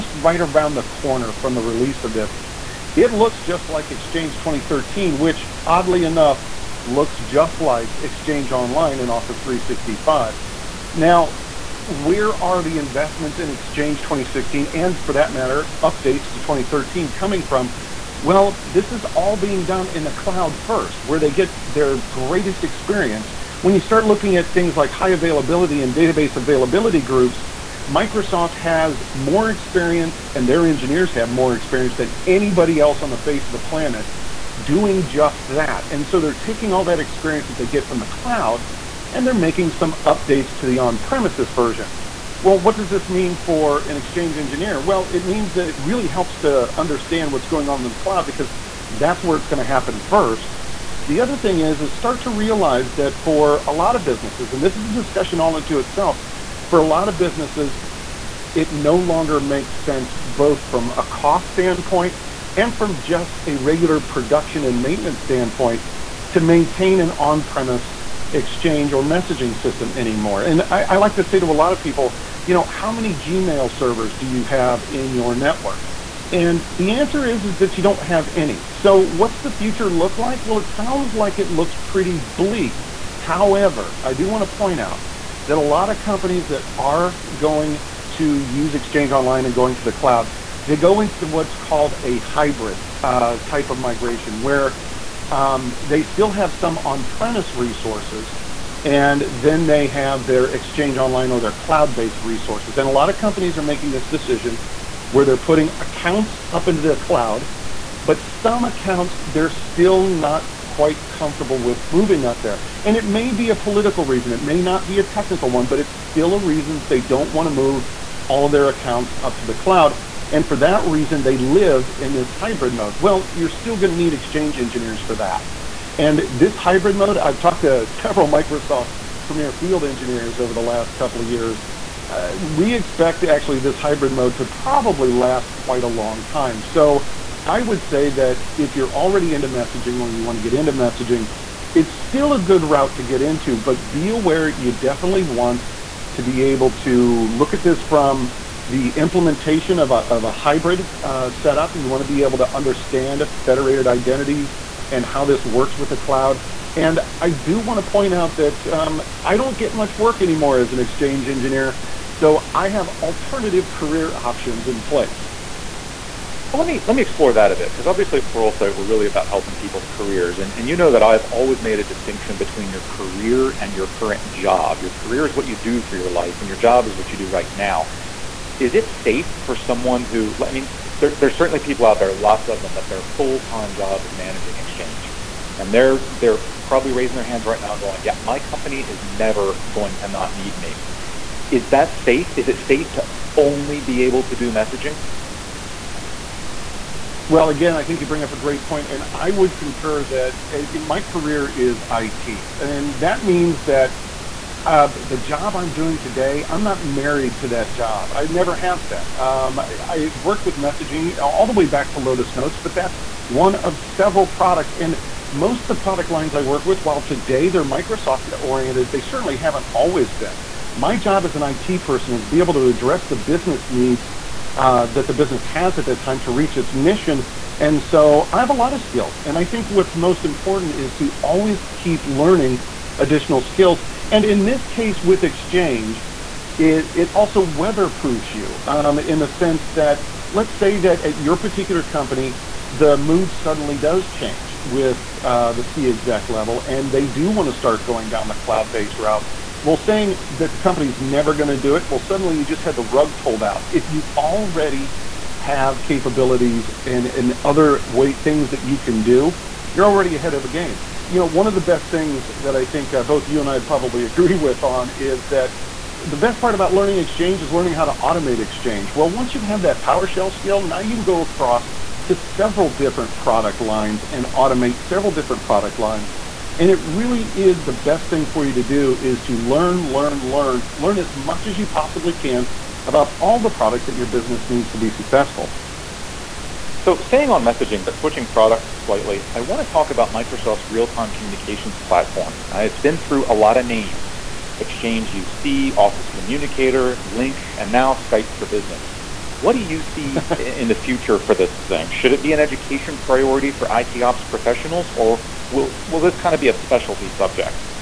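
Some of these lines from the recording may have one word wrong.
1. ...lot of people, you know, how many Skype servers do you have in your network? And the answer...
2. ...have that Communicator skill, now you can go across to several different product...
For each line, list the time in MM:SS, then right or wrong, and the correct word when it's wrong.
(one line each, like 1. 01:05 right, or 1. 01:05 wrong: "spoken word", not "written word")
1. 01:11 wrong: "Gmail", not "Skype"
2. 04:29 wrong: "PowerShell", not "Communicator".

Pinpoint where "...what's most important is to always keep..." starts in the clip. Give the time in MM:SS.
03:49.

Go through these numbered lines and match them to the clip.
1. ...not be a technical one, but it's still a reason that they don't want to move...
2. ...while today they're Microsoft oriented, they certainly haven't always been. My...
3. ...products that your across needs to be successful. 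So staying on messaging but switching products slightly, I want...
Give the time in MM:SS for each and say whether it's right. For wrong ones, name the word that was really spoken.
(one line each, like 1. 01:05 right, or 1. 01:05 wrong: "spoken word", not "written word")
1. 01:54 right
2. 03:36 right
3. 04:43 wrong: "business", not "across".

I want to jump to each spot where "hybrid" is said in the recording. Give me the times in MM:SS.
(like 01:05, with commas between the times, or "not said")
01:32, 02:02, 02:06, 02:13, 02:30.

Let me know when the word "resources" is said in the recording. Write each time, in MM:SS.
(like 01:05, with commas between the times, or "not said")
01:37, 01:42.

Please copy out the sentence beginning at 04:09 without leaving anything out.
Well, saying that the company's never going to do it, well, suddenly you just had the rug pulled out.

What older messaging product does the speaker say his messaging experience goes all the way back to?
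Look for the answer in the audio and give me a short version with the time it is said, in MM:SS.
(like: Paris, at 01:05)
Lotus Notes, at 03:31.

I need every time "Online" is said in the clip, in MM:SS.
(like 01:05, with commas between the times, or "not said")
00:08, 01:29, 01:40.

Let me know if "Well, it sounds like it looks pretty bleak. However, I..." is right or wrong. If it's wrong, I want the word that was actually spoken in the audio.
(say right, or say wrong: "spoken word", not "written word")
right.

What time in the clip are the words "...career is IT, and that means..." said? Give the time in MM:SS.
03:21.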